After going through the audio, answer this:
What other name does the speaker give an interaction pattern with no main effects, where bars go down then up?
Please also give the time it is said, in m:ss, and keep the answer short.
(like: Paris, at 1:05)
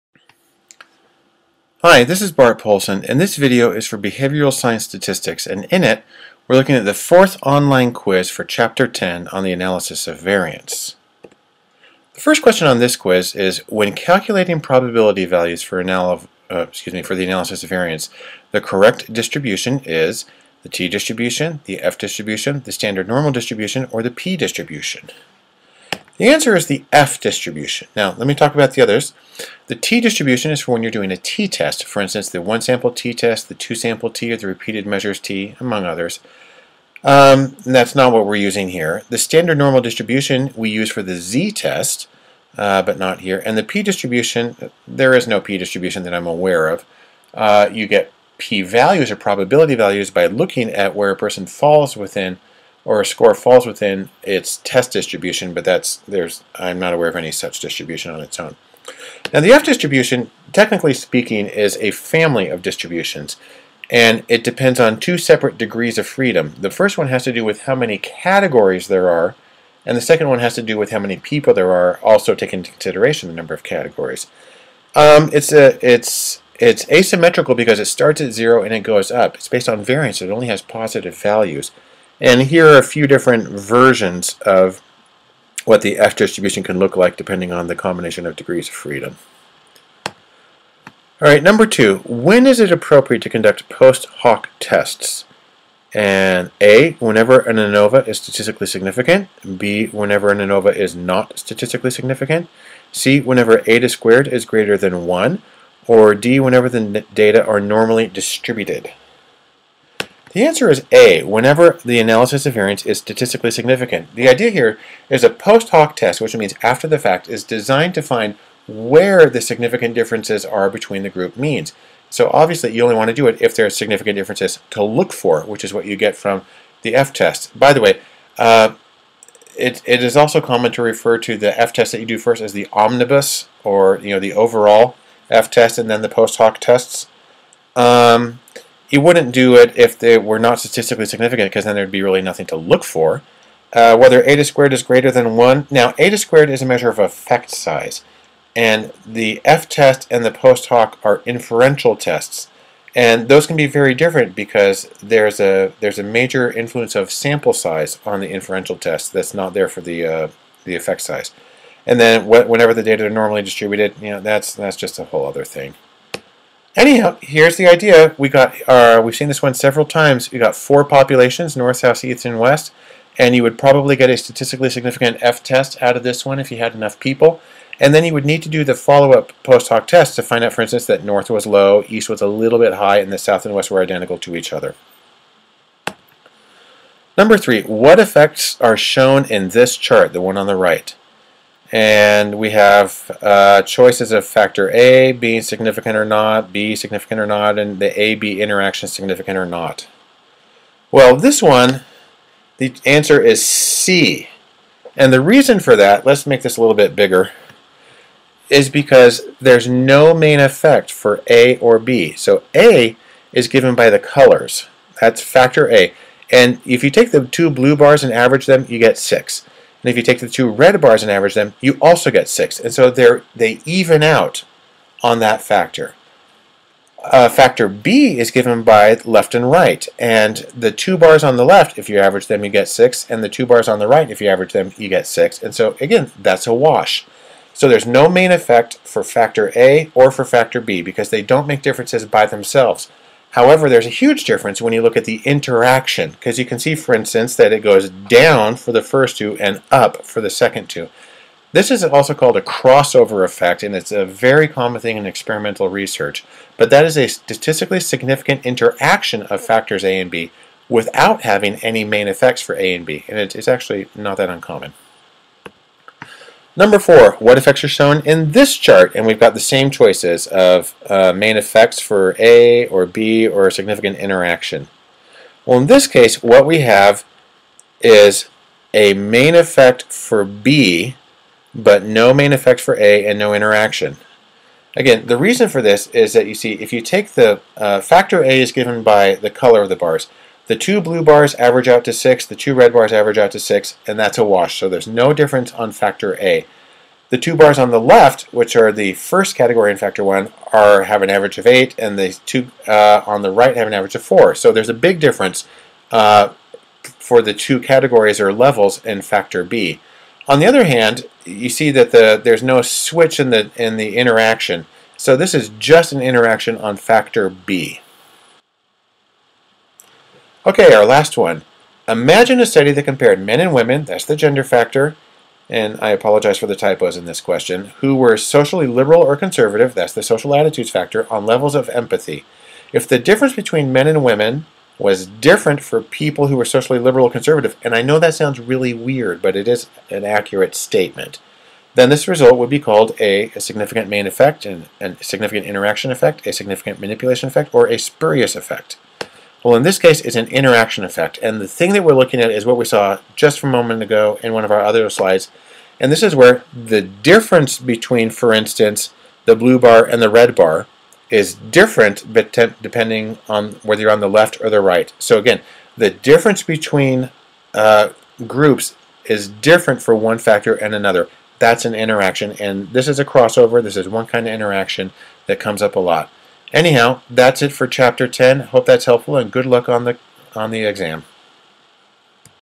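Crossover effect, at 4:12.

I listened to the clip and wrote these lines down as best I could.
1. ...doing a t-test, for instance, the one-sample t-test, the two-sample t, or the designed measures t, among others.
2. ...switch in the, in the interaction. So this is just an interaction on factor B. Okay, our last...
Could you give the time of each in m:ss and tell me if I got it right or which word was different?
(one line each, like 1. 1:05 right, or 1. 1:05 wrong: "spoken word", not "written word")
1. 0:30 wrong: "repeated", not "designed"
2. 5:12 right.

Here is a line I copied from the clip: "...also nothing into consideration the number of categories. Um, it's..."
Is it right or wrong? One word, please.
wrong.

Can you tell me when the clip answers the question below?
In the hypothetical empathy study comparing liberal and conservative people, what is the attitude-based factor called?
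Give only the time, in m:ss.
5:30.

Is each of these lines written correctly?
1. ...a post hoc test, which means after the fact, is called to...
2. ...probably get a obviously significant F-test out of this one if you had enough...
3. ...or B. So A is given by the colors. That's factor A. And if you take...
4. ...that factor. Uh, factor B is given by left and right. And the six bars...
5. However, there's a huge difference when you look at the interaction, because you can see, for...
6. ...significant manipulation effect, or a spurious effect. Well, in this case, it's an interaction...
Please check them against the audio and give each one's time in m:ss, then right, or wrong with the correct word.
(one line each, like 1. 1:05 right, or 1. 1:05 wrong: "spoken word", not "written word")
1. 1:55 wrong: "designed", not "called"
2. 2:53 wrong: "statistically", not "obviously"
3. 3:31 right
4. 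3:45 wrong: "two", not "six"
5. 4:03 right
6. 5:46 right.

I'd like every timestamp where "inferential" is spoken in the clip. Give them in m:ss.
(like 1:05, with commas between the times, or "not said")
2:31, 2:38.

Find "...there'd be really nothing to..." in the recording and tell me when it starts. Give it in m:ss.
2:21.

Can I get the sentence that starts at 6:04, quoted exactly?
So again, the difference between uh, groups is different for one factor and another.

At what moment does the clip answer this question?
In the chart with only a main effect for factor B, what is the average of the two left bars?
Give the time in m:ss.
5:01.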